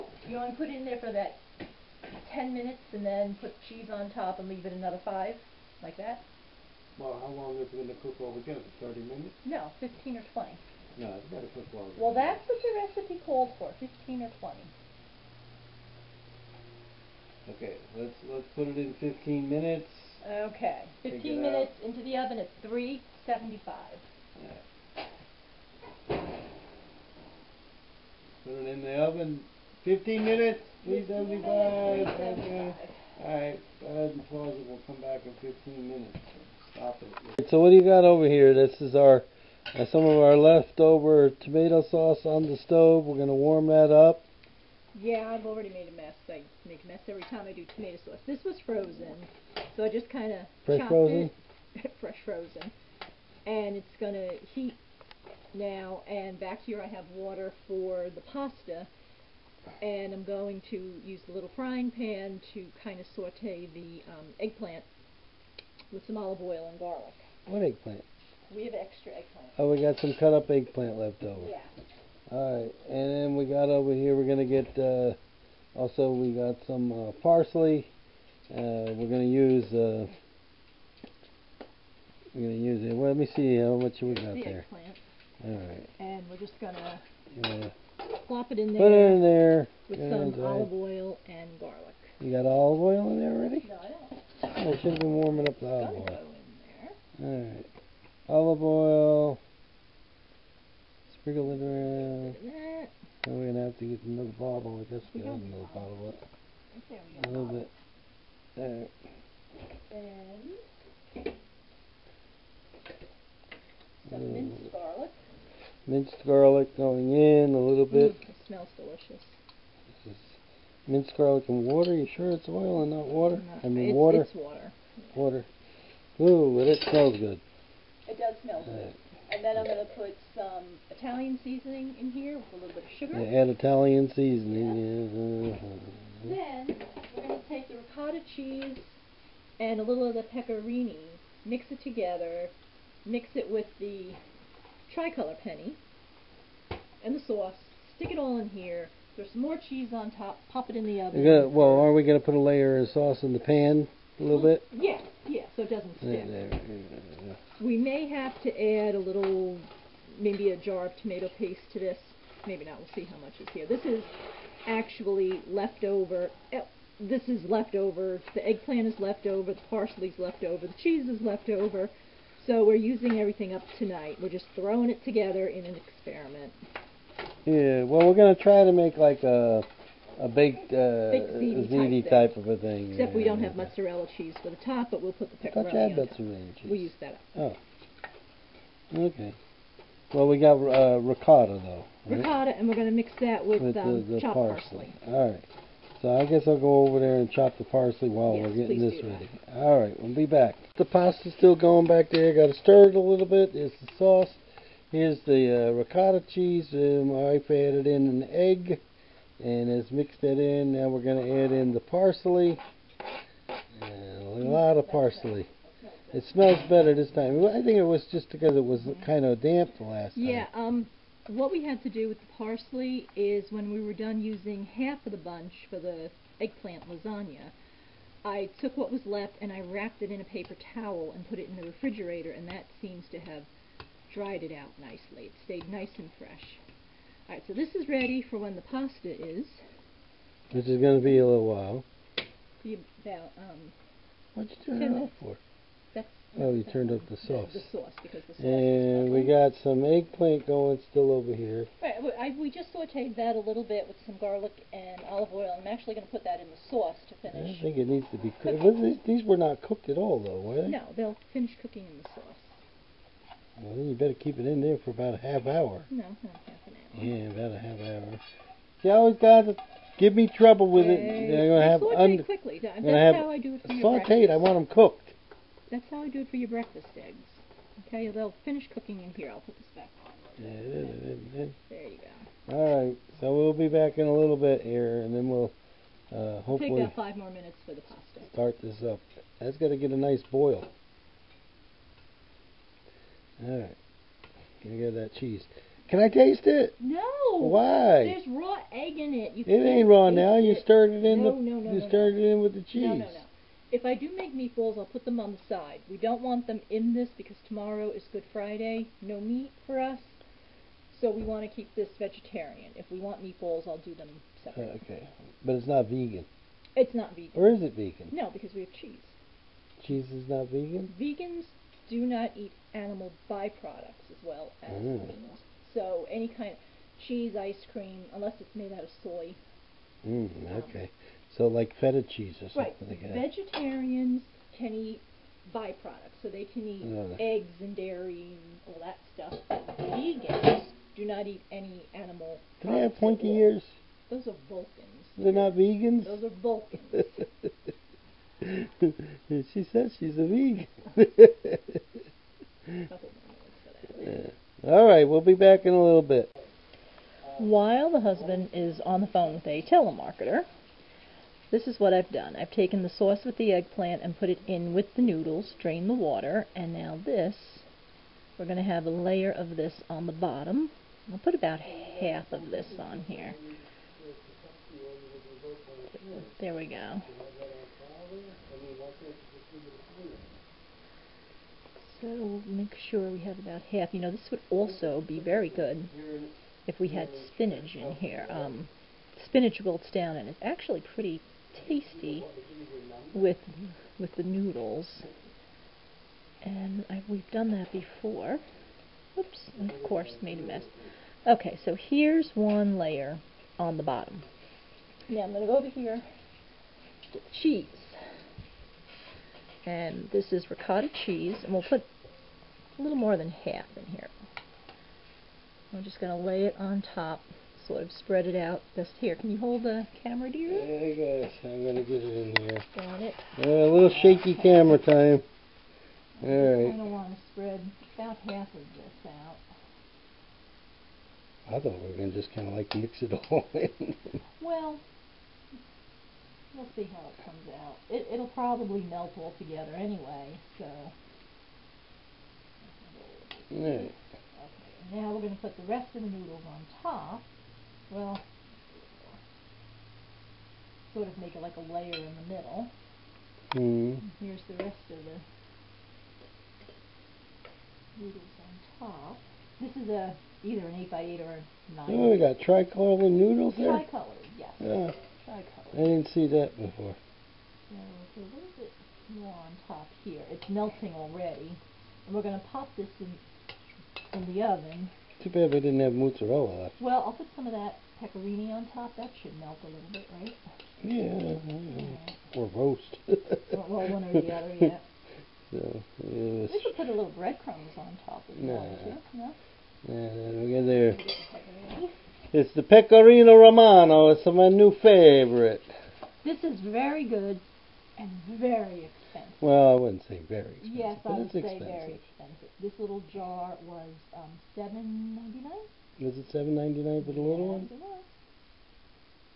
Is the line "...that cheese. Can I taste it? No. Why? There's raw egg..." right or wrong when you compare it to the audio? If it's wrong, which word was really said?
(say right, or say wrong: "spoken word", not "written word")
right.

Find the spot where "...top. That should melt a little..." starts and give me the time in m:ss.
7:58.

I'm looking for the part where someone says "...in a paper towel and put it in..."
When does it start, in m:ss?
3:50.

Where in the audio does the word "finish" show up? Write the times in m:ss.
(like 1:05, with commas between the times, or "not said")
4:17, 4:21, 4:38.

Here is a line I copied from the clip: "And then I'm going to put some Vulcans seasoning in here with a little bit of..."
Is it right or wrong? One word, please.
wrong.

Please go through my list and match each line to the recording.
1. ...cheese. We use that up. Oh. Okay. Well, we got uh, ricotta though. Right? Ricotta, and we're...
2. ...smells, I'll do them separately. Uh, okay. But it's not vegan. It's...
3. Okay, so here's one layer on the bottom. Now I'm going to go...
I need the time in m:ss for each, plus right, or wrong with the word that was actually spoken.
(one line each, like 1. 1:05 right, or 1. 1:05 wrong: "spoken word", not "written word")
1. 3:06 right
2. 5:13 wrong: "meatballs", not "smells"
3. 6:41 right.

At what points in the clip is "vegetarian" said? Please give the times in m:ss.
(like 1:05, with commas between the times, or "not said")
5:11, 5:33.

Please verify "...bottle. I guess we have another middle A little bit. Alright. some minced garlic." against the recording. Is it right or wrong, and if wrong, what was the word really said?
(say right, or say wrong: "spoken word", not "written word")
wrong: "bottle", not "middle".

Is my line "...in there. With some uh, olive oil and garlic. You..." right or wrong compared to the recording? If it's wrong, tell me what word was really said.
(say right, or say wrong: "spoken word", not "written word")
right.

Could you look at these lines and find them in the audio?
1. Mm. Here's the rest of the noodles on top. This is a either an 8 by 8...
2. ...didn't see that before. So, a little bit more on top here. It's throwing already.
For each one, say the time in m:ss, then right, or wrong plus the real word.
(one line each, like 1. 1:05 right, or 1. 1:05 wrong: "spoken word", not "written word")
1. 7:33 right
2. 7:45 wrong: "melting", not "throwing".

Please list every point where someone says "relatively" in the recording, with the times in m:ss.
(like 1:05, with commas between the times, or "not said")
not said.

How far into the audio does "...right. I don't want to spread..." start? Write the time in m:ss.
7:06.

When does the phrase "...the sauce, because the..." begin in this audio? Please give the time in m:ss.
4:07.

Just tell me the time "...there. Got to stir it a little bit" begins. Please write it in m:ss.
3:22.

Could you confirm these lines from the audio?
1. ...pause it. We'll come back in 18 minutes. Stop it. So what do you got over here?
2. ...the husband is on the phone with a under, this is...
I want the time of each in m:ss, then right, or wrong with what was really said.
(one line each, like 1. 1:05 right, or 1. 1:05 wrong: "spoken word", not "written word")
1. 0:34 wrong: "15", not "18"
2. 5:57 wrong: "telemarketer", not "under".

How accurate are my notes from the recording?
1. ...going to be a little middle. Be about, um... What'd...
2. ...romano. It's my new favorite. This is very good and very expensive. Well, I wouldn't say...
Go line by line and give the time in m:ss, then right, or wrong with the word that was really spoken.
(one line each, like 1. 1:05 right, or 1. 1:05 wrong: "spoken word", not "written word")
1. 4:00 wrong: "while", not "middle"
2. 8:13 right.